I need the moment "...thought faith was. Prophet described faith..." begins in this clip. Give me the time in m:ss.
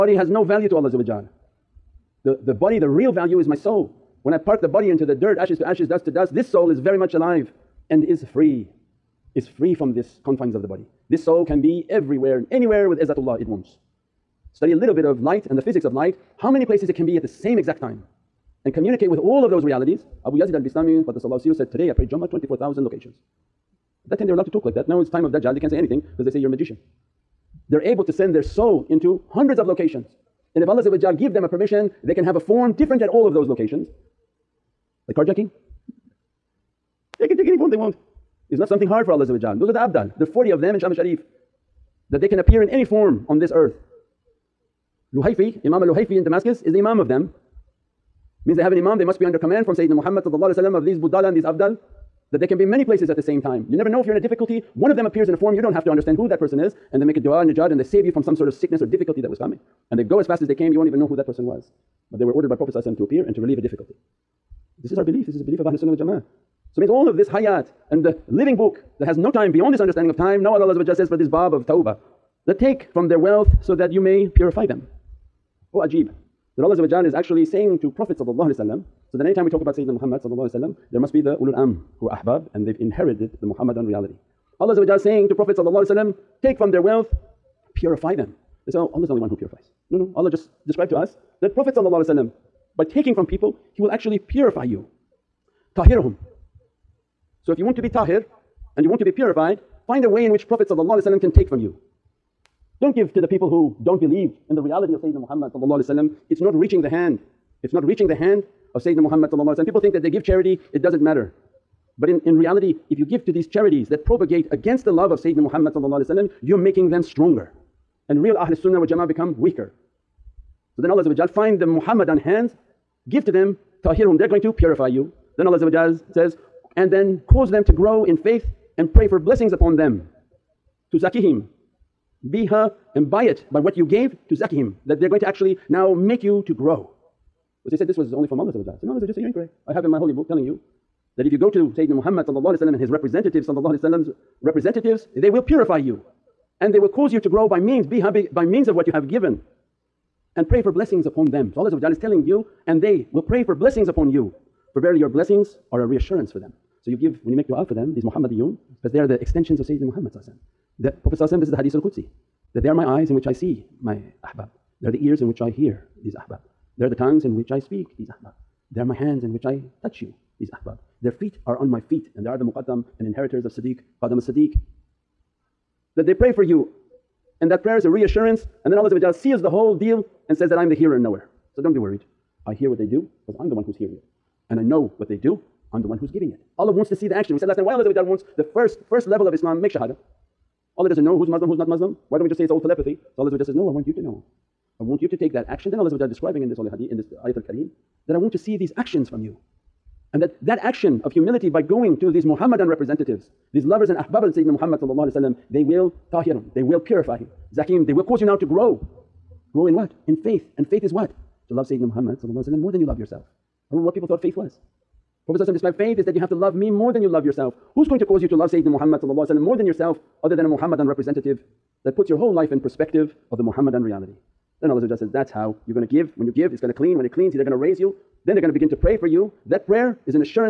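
3:34.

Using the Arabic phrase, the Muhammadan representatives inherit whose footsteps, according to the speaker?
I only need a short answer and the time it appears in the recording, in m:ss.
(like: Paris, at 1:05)
qadam as-siddiq, at 2:54.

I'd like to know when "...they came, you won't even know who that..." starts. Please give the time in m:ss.
1:00.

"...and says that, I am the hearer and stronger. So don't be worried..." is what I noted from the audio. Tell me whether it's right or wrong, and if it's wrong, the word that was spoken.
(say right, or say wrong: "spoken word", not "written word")
wrong: "knower", not "stronger".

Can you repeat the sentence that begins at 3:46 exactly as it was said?
When you give it's going to clean, when it cleans they're going to raise you.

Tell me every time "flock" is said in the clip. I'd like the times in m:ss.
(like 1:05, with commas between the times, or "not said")
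not said.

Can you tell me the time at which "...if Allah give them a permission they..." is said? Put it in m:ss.
0:30.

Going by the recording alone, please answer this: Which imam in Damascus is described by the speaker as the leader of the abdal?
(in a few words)
Imam al-Luhayfi.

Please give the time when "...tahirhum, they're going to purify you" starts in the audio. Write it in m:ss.
2:03.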